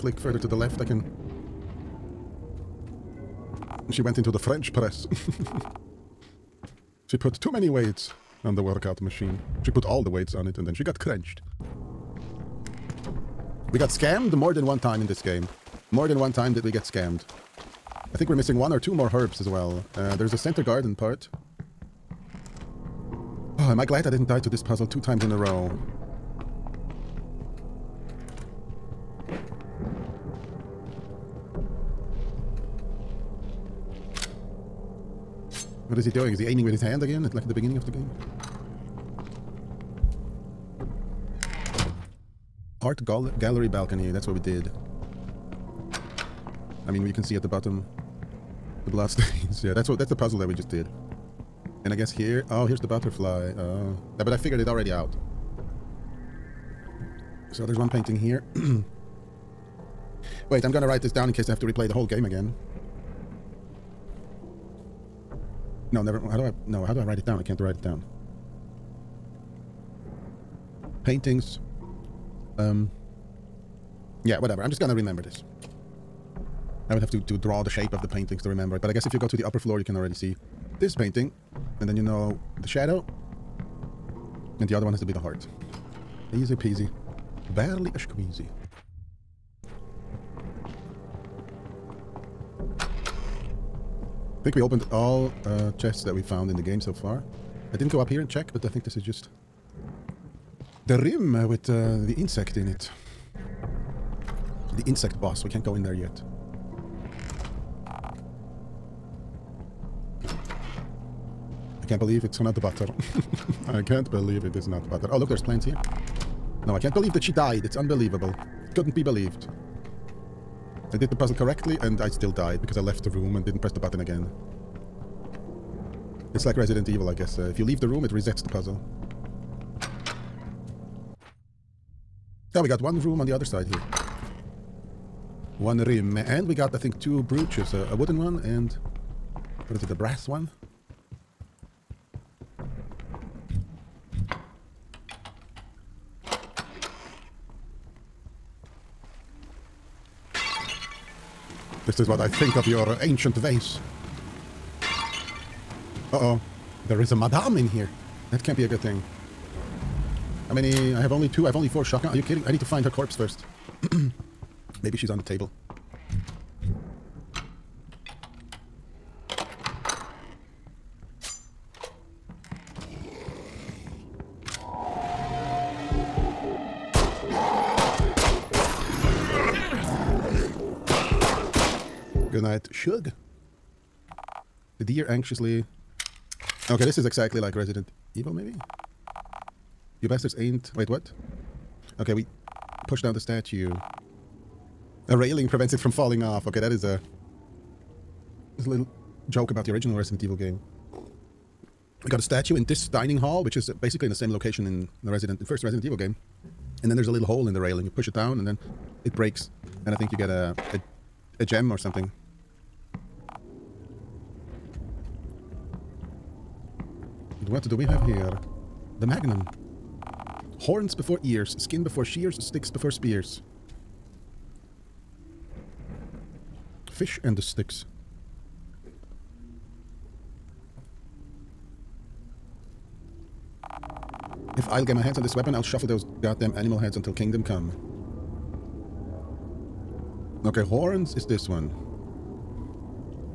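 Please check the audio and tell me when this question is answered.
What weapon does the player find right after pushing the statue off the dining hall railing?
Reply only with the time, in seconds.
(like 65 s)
218 s.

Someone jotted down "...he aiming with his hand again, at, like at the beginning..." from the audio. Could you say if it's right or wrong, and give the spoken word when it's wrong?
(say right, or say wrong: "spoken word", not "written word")
right.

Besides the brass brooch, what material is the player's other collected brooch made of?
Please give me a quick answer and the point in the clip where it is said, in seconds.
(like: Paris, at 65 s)
wooden, at 137 s.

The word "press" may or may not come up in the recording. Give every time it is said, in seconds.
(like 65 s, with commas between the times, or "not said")
4 s, 123 s.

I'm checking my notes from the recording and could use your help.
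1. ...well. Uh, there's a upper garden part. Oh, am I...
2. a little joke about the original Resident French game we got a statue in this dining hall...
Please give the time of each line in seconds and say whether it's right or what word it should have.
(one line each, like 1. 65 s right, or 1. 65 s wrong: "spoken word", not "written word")
1. 19 s wrong: "center", not "upper"
2. 198 s wrong: "Evil", not "French".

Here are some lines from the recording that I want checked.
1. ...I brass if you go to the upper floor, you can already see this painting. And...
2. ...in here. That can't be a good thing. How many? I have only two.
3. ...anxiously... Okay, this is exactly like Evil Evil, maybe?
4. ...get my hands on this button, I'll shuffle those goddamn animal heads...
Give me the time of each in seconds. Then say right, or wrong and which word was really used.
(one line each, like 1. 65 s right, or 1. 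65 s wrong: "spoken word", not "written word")
1. 78 s wrong: "guess", not "brass"
2. 157 s right
3. 185 s wrong: "Resident", not "Evil"
4. 234 s wrong: "weapon", not "button".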